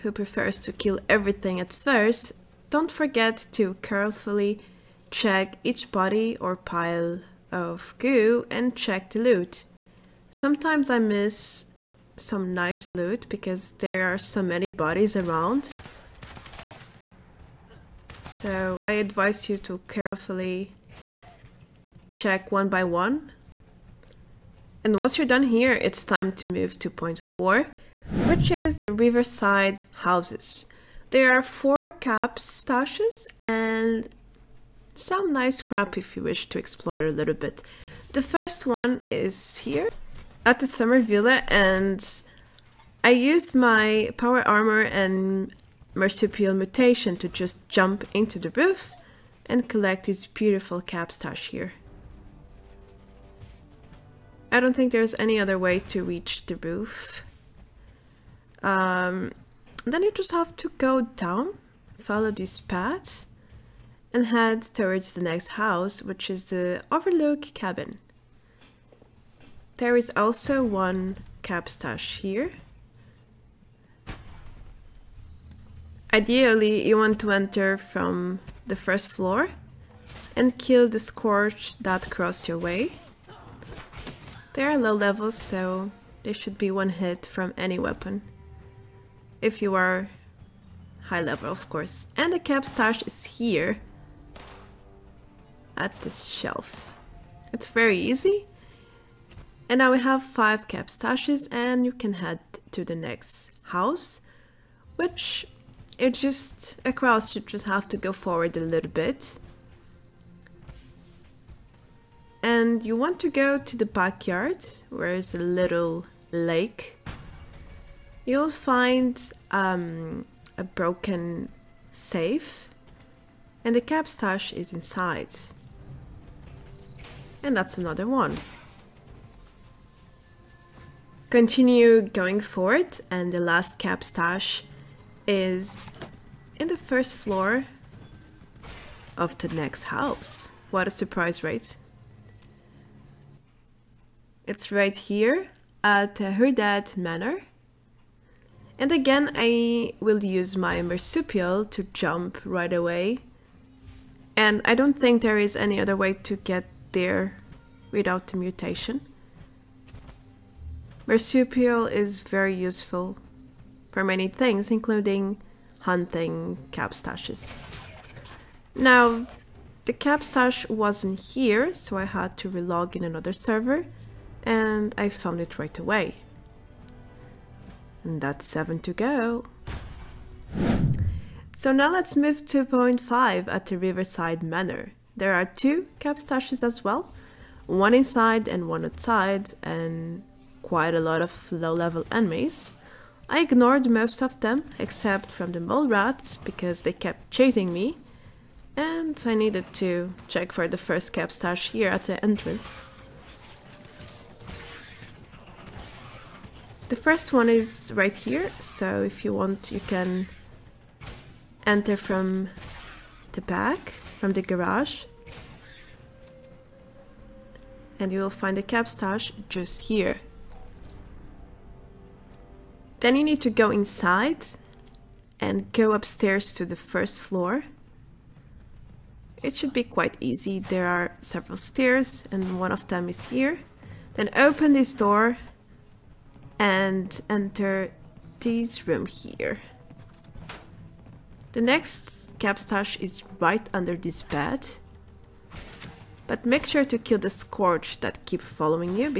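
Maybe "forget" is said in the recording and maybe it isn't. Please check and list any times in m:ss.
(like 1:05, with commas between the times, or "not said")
0:02.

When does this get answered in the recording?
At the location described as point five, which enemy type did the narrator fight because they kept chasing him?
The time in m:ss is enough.
3:15.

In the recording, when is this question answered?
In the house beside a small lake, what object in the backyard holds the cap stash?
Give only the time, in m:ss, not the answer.
2:00.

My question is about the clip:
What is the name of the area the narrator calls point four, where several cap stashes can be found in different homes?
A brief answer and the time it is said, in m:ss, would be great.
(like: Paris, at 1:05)
Riverside Houses, at 0:28.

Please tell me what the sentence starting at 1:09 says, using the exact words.
There is also one cap stash here.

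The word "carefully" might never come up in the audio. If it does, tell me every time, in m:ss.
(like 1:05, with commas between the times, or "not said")
0:03, 0:19.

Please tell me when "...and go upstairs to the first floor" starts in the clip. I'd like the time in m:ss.
3:45.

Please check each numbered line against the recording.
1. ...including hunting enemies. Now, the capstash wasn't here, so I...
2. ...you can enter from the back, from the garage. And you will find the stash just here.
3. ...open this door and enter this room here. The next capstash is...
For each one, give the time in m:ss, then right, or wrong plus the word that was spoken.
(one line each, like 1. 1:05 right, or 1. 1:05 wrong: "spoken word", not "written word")
1. 2:44 wrong: "capstashes", not "enemies"
2. 3:29 right
3. 3:54 right.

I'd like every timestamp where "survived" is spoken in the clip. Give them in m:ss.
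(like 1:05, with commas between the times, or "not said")
not said.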